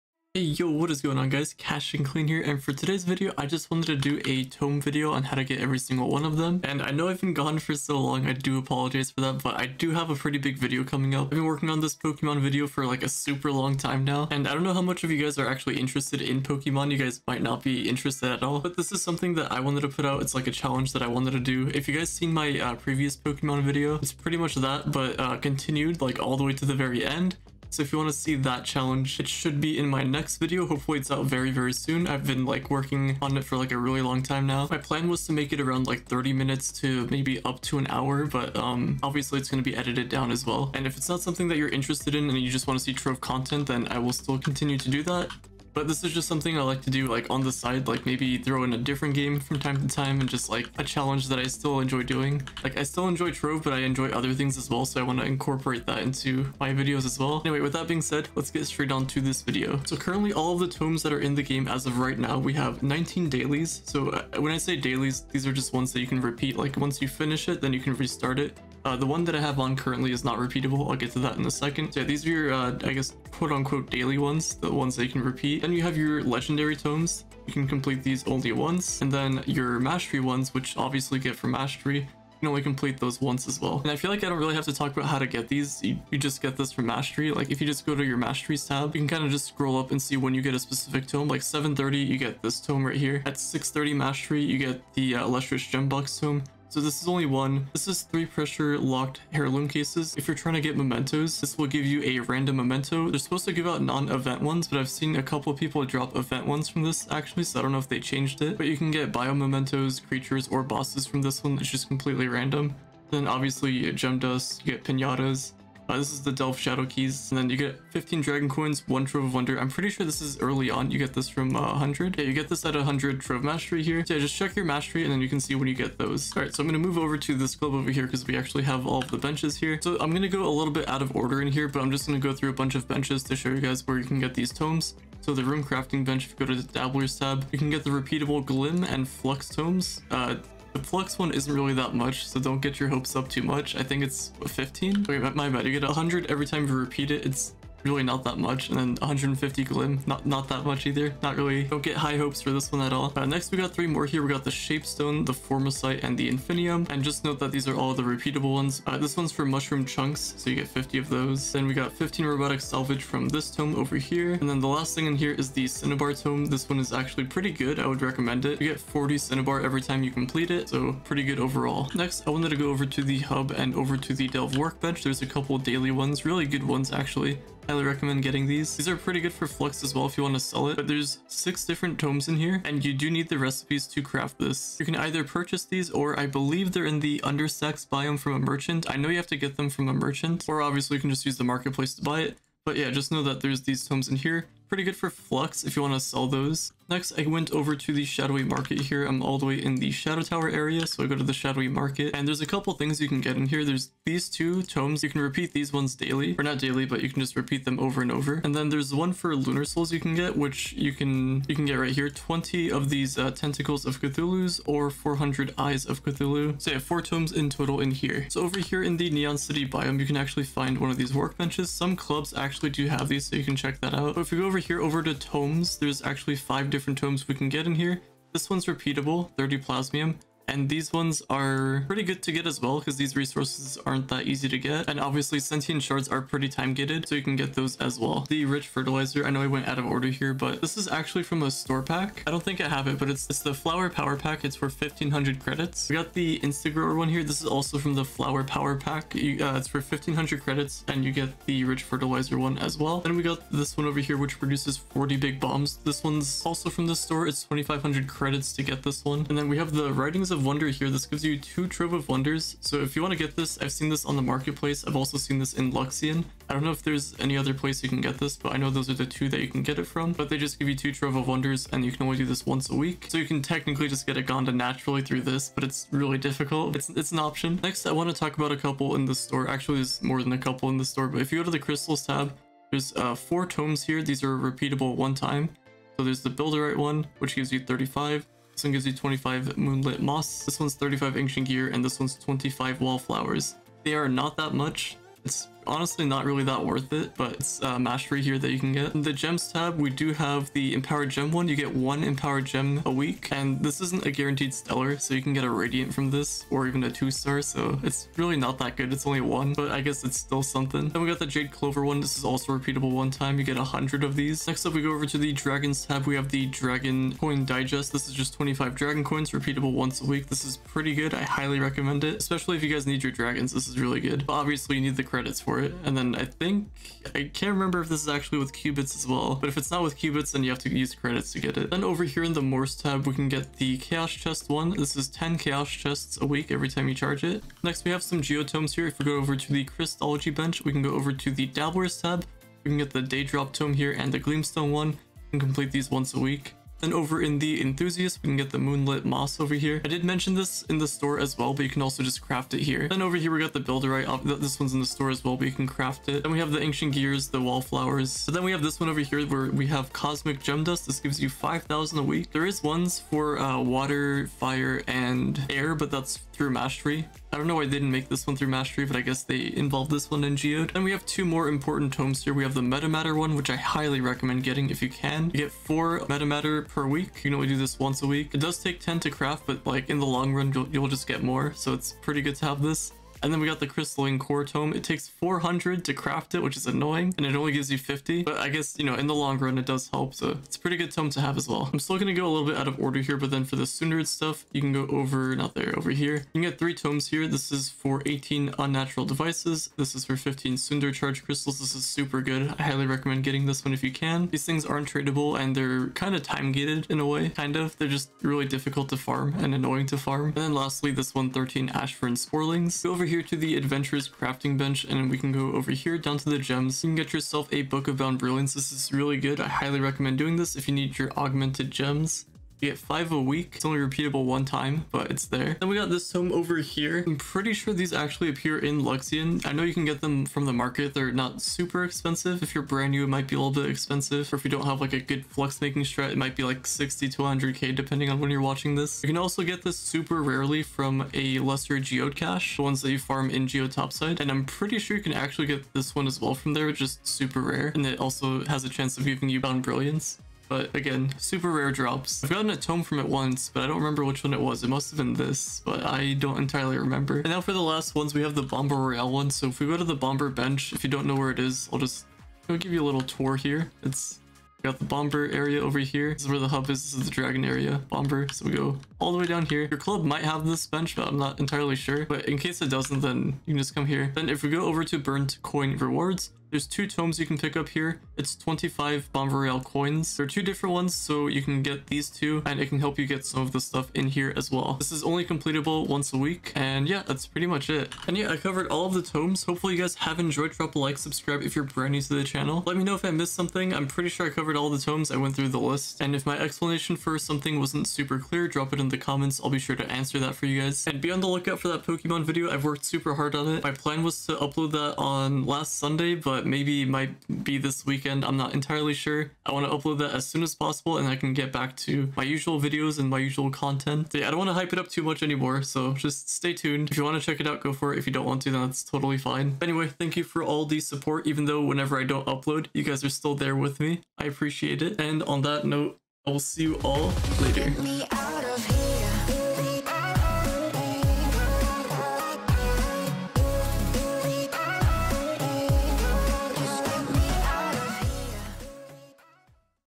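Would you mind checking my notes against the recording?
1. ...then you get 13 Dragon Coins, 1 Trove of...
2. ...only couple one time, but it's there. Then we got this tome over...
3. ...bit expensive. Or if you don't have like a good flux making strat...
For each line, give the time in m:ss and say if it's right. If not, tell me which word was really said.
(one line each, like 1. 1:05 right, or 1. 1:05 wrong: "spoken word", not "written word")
1. 1:57 wrong: "15", not "13"
2. 7:03 wrong: "repeatable", not "couple"
3. 7:13 right.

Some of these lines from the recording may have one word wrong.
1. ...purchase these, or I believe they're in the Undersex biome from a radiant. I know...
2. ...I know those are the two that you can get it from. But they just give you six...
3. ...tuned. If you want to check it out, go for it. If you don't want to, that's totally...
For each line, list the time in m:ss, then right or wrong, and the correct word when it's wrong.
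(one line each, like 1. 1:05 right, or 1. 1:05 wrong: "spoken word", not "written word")
1. 3:05 wrong: "merchant", not "radiant"
2. 4:28 wrong: "two", not "six"
3. 8:36 right.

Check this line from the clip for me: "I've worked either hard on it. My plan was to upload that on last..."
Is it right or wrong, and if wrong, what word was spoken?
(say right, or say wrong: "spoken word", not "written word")
wrong: "super", not "either".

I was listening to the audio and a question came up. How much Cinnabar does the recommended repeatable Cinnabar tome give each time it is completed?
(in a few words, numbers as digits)
40.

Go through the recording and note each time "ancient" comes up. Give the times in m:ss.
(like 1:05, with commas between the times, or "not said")
4:51, 5:56.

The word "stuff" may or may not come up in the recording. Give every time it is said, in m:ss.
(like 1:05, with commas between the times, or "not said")
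6:34, 8:03.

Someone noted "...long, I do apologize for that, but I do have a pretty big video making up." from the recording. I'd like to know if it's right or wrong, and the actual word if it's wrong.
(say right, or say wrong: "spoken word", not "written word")
wrong: "coming", not "making".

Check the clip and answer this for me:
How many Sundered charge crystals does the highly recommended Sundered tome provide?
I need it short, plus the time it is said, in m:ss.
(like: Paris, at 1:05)
15, at 6:40.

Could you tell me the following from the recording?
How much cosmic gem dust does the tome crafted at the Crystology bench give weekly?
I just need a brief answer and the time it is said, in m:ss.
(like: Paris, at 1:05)
5,000, at 6:01.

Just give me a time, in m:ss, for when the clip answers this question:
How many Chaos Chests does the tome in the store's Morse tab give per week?
5:35.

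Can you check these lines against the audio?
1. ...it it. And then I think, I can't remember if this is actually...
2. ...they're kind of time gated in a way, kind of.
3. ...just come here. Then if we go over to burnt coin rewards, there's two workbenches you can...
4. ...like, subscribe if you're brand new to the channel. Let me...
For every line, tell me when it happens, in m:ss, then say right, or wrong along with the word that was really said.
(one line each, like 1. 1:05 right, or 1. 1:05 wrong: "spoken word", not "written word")
1. 5:25 right
2. 6:45 right
3. 7:53 wrong: "tomes", not "workbenches"
4. 8:10 right.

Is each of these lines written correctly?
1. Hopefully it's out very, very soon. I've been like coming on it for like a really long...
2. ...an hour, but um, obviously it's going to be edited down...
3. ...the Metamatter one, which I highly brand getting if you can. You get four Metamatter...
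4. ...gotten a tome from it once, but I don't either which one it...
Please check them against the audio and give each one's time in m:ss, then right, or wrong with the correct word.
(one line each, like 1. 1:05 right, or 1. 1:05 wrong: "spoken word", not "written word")
1. 0:30 wrong: "working", not "coming"
2. 0:37 right
3. 6:12 wrong: "recommend", not "brand"
4. 7:32 wrong: "remember", not "either".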